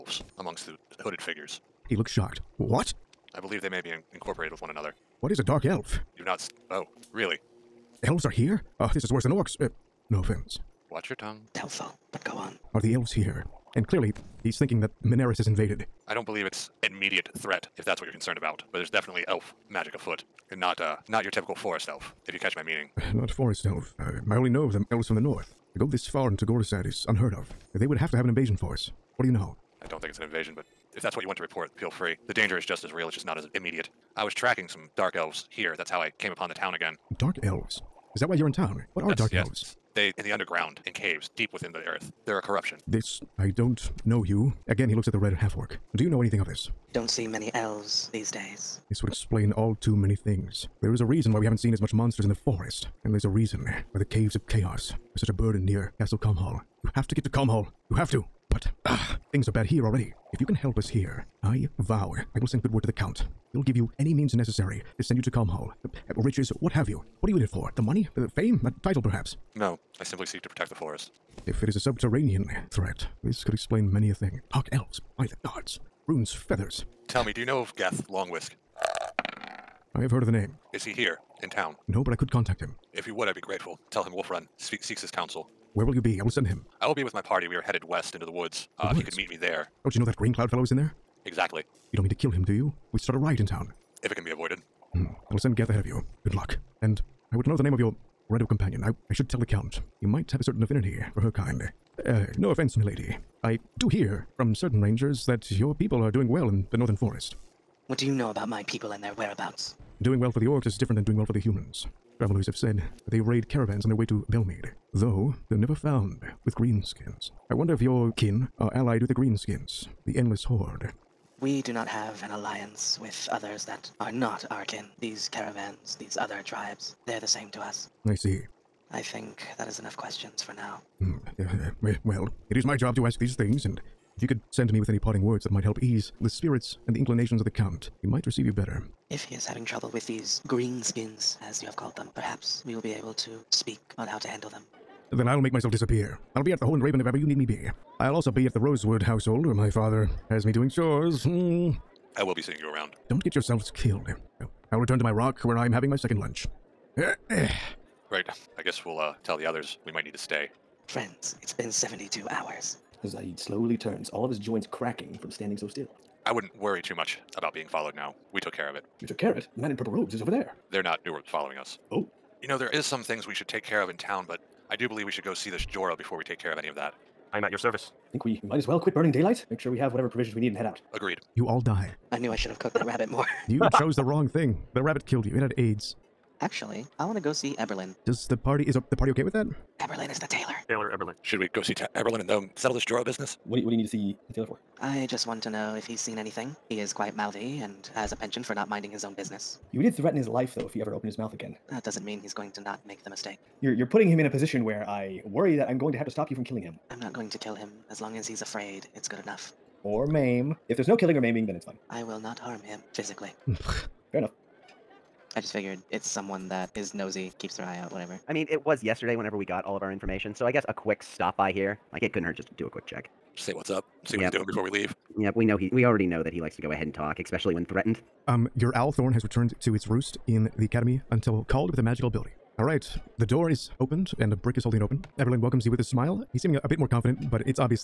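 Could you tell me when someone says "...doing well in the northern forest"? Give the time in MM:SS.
01:46.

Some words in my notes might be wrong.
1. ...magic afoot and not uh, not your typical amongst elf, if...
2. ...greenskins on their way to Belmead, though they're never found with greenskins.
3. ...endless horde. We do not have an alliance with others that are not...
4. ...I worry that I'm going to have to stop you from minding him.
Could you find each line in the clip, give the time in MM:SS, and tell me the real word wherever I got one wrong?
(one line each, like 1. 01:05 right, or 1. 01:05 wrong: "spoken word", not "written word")
1. 00:19 wrong: "forest", not "amongst"
2. 01:53 wrong: "caravans", not "greenskins"
3. 02:00 right
4. 03:24 wrong: "killing", not "minding".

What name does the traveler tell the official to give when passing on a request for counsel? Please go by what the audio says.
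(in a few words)
Wolf.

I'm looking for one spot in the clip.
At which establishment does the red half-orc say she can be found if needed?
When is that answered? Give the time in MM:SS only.
02:26.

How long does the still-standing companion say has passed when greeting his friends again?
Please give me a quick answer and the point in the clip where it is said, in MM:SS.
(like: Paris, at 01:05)
72 hours, at 02:41.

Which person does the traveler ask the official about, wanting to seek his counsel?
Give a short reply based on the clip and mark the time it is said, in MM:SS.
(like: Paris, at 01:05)
Gath Longwhisk, at 01:17.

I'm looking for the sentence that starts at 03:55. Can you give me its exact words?
Everlyn welcomes you with a smile.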